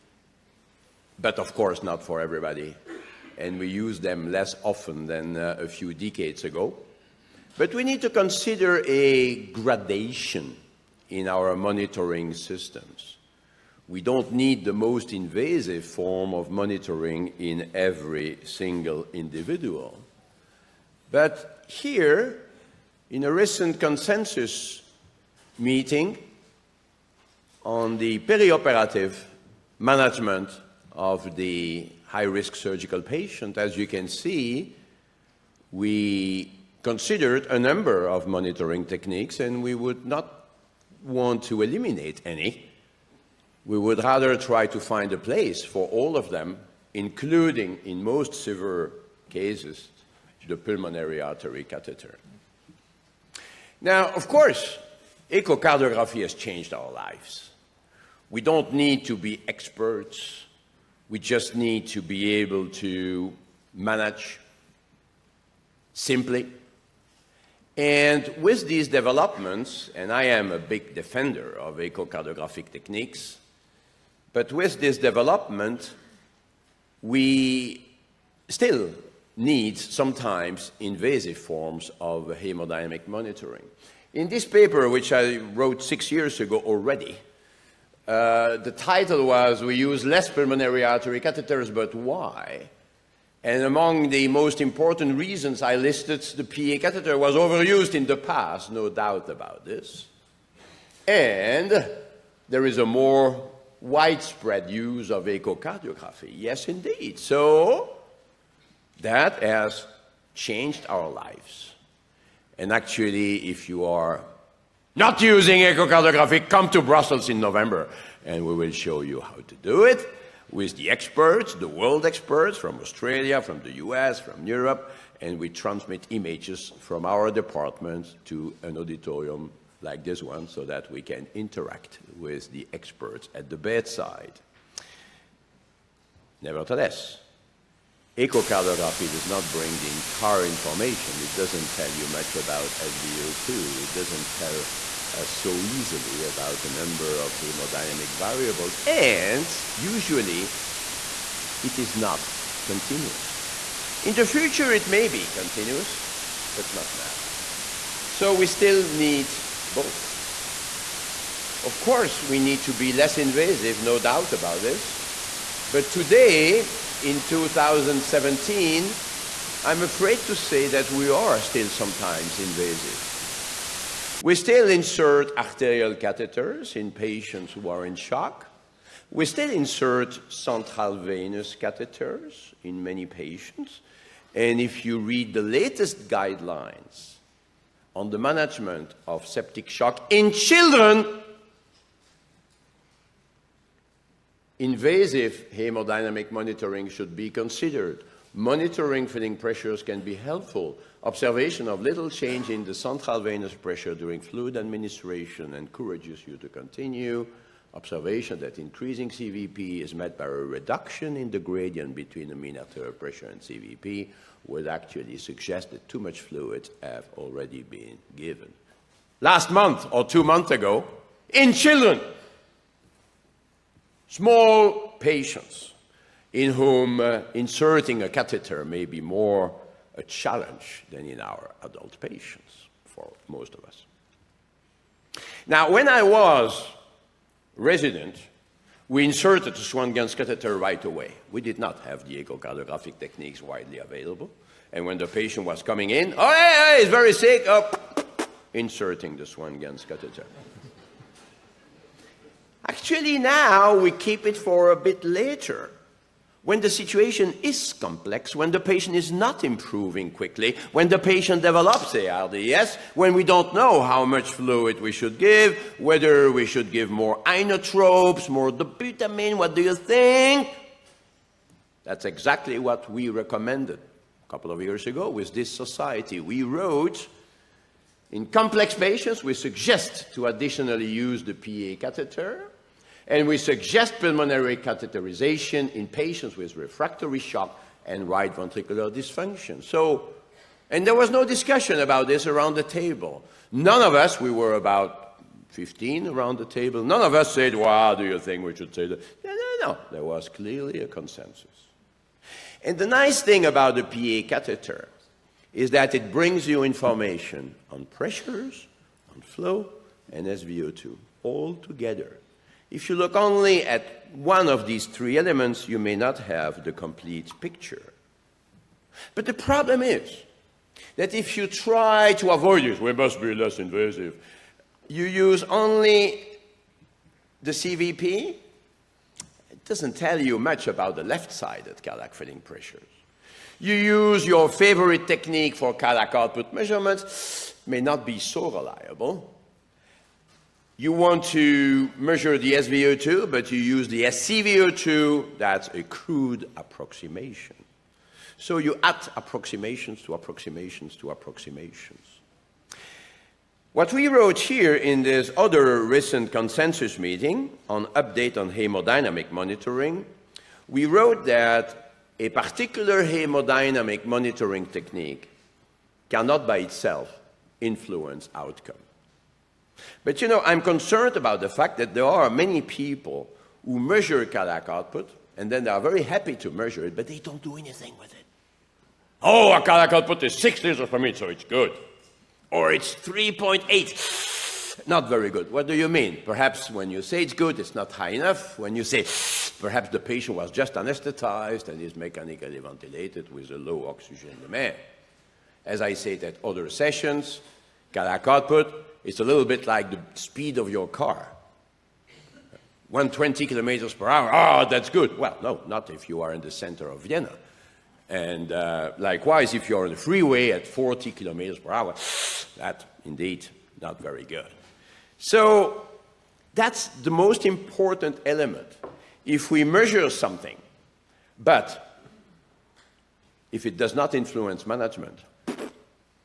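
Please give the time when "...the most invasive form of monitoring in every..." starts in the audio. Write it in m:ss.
0:14.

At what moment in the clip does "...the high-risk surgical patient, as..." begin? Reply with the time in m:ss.
0:31.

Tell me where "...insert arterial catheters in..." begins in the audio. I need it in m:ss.
2:54.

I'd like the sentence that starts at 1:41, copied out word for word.
And there is a more widespread use of echocardiography.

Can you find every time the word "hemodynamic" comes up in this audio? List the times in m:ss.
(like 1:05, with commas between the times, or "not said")
1:22, 2:27, 3:15, 5:58, 6:03.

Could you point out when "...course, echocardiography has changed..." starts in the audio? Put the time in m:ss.
0:54.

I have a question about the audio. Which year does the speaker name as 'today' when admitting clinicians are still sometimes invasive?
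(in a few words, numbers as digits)
2017.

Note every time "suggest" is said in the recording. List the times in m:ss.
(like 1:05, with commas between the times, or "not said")
3:35, 4:39, 4:43.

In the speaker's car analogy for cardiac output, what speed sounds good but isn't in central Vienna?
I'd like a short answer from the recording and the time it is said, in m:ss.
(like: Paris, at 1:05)
120 km/h, at 6:42.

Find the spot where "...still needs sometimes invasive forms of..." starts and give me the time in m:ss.
1:18.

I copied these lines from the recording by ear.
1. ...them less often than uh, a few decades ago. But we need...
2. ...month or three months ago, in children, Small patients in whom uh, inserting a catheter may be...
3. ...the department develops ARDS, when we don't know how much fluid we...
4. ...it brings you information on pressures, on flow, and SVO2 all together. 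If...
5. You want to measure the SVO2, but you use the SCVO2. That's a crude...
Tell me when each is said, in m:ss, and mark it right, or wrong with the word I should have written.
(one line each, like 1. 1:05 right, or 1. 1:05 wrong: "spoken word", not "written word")
1. 0:03 right
2. 3:39 wrong: "two", not "three"
3. 4:20 wrong: "patient", not "department"
4. 5:05 right
5. 5:40 right.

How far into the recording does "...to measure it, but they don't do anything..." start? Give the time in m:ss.
6:16.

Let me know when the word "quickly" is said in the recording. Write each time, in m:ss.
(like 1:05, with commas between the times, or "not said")
4:20.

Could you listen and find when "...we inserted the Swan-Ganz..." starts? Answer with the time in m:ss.
3:58.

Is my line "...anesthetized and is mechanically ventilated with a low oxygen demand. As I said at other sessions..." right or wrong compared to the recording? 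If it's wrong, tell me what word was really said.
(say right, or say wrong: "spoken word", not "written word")
right.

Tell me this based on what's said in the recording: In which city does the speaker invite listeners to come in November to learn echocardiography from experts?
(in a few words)
Brussels.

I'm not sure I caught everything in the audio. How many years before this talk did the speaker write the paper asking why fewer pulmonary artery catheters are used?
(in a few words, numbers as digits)
6.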